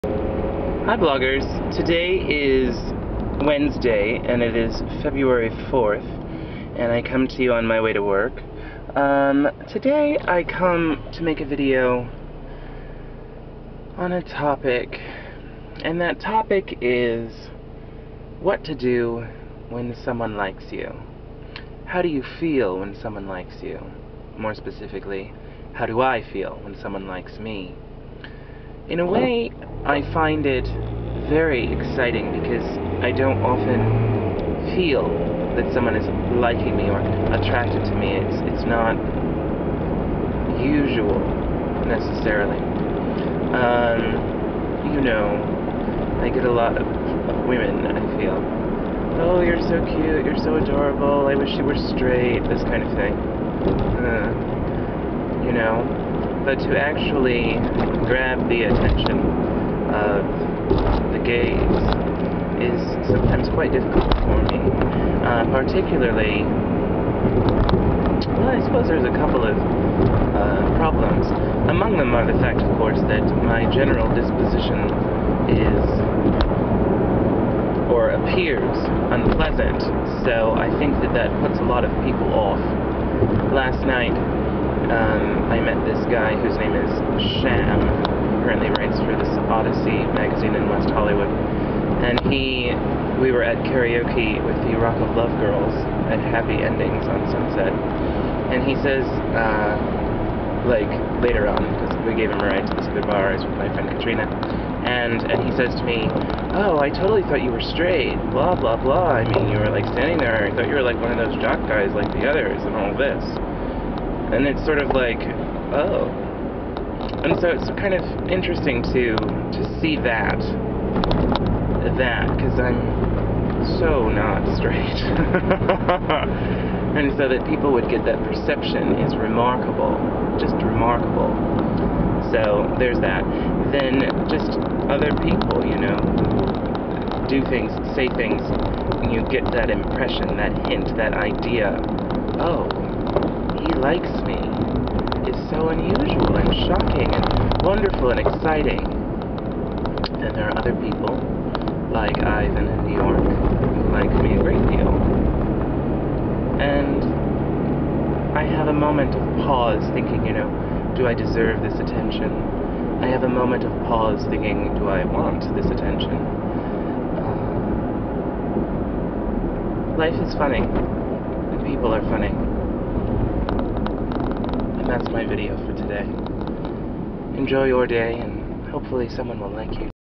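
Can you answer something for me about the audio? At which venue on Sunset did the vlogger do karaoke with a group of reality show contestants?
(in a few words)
Happy Endings.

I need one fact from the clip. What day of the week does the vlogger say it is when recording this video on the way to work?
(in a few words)
Wednesday.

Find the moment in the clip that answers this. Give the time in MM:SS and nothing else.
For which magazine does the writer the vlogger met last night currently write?
01:29.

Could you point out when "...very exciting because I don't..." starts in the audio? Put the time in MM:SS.
00:31.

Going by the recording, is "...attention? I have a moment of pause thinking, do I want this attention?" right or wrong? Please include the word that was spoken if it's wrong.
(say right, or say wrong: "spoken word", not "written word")
right.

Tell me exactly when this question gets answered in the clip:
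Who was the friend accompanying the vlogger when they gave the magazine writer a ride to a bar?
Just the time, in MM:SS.
01:43.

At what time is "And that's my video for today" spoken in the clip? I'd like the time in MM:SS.
02:54.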